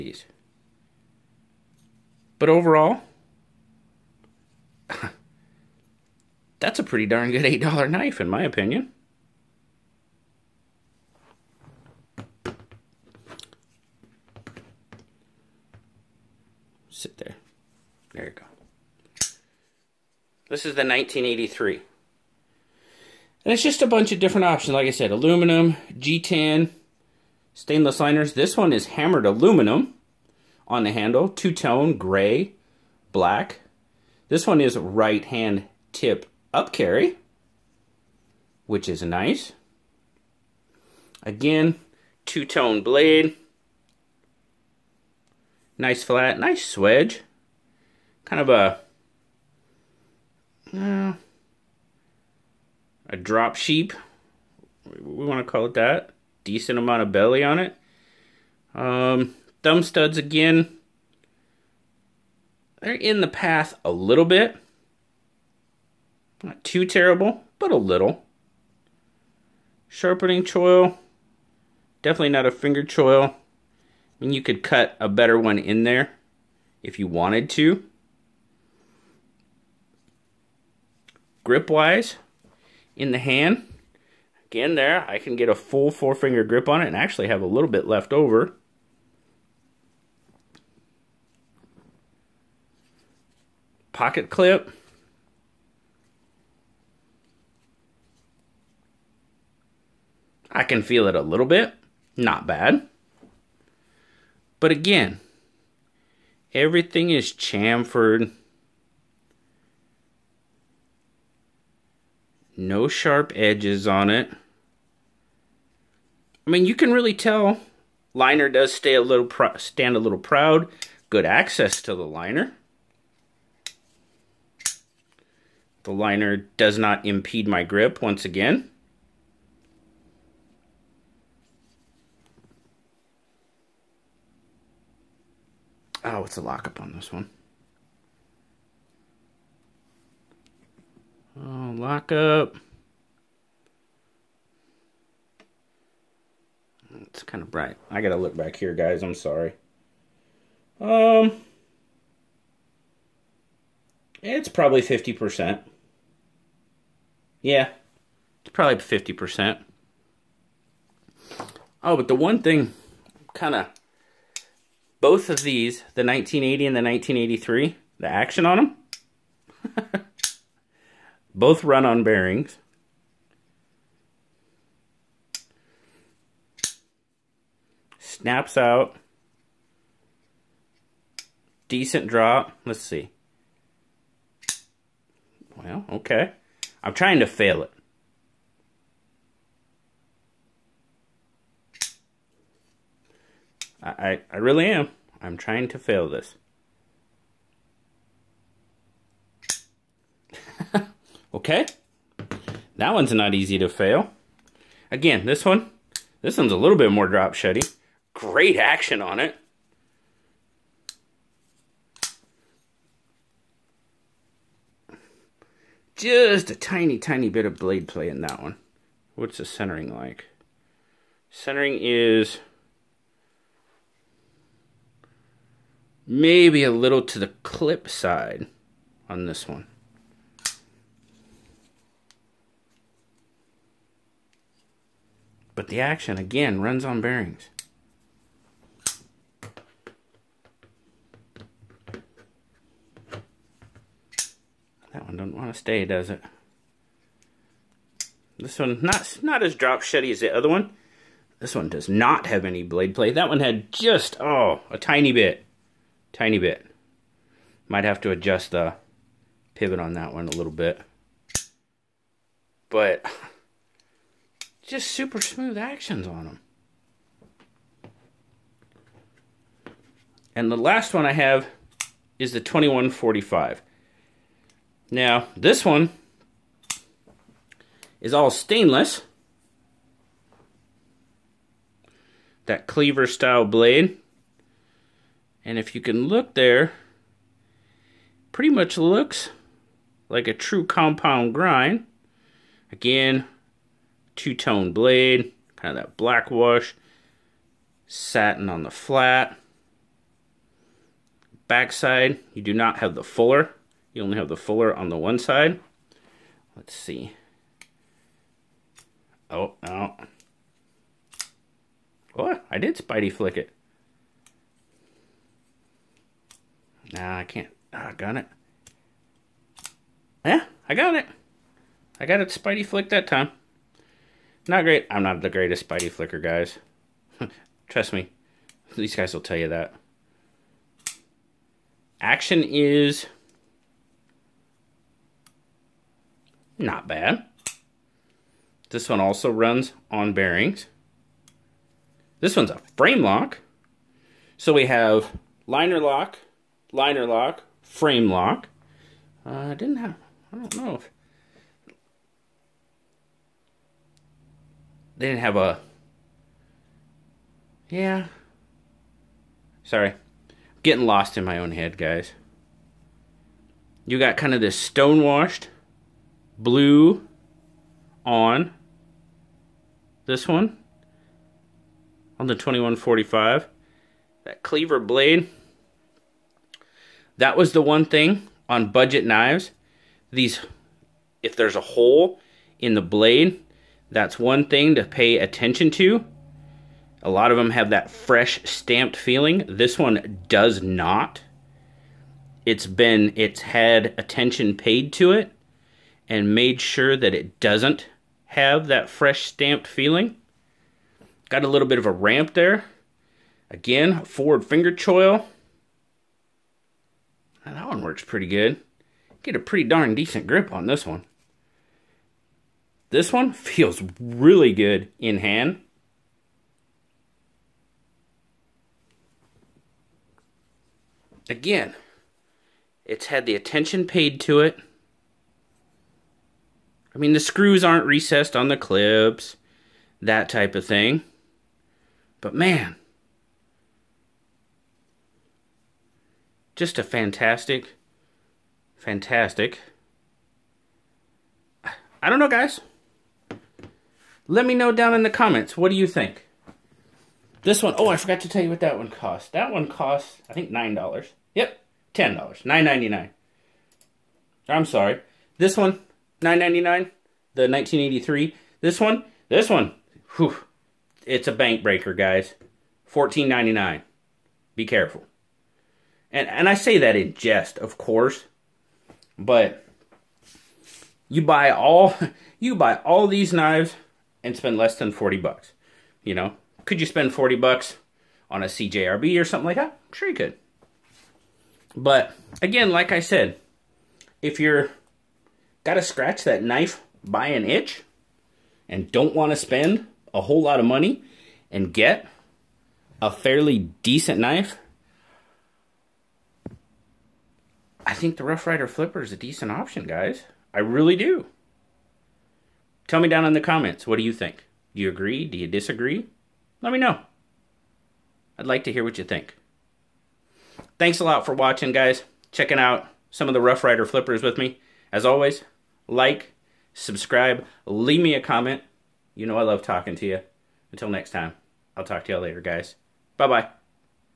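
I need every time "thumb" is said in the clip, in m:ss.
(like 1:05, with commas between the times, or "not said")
0:59.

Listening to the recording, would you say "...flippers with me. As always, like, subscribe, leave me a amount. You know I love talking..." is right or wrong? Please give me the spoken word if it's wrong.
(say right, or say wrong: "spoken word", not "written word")
wrong: "comment", not "amount".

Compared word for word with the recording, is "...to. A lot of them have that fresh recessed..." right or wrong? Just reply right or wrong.
wrong.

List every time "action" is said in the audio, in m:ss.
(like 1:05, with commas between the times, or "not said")
2:48, 3:28, 3:55, 4:25, 5:31.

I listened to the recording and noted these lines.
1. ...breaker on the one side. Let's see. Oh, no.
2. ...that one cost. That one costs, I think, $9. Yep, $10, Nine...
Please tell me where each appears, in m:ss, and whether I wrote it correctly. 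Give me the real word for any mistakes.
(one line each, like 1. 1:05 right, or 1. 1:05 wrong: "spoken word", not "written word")
1. 5:04 wrong: "fuller", not "breaker"
2. 7:28 right.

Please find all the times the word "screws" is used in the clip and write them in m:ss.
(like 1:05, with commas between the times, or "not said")
7:07.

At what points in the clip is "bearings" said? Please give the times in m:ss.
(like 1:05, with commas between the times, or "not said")
2:52, 3:56, 5:40.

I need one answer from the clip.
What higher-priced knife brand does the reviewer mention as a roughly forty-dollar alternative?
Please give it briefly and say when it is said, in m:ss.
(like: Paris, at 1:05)
CJRB, at 7:58.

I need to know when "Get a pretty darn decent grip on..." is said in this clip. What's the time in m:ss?
6:49.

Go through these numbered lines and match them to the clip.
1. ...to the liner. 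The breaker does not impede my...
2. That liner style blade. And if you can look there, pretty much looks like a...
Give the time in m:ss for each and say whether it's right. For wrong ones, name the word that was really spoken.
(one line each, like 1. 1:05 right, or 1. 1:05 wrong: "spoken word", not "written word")
1. 2:01 wrong: "liner", not "breaker"
2. 4:42 wrong: "cleaver", not "liner".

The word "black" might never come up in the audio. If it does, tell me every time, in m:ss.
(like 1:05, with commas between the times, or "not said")
0:33, 4:55.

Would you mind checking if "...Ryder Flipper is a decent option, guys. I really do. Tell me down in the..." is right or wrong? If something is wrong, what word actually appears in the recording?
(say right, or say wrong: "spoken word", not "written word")
right.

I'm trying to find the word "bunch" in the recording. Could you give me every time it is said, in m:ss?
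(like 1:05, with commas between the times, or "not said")
0:23.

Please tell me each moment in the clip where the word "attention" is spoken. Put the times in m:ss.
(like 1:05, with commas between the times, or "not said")
6:25, 6:33, 7:03.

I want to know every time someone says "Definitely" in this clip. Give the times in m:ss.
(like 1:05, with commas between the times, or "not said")
1:12.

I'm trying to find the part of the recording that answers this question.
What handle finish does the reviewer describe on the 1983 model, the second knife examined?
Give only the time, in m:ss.
0:28.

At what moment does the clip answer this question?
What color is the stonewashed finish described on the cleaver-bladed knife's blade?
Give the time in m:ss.
6:06.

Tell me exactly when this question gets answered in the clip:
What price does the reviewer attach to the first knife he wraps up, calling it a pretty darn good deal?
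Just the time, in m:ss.
0:07.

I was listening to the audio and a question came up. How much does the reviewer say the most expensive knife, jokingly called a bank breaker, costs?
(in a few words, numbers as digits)
$14.99.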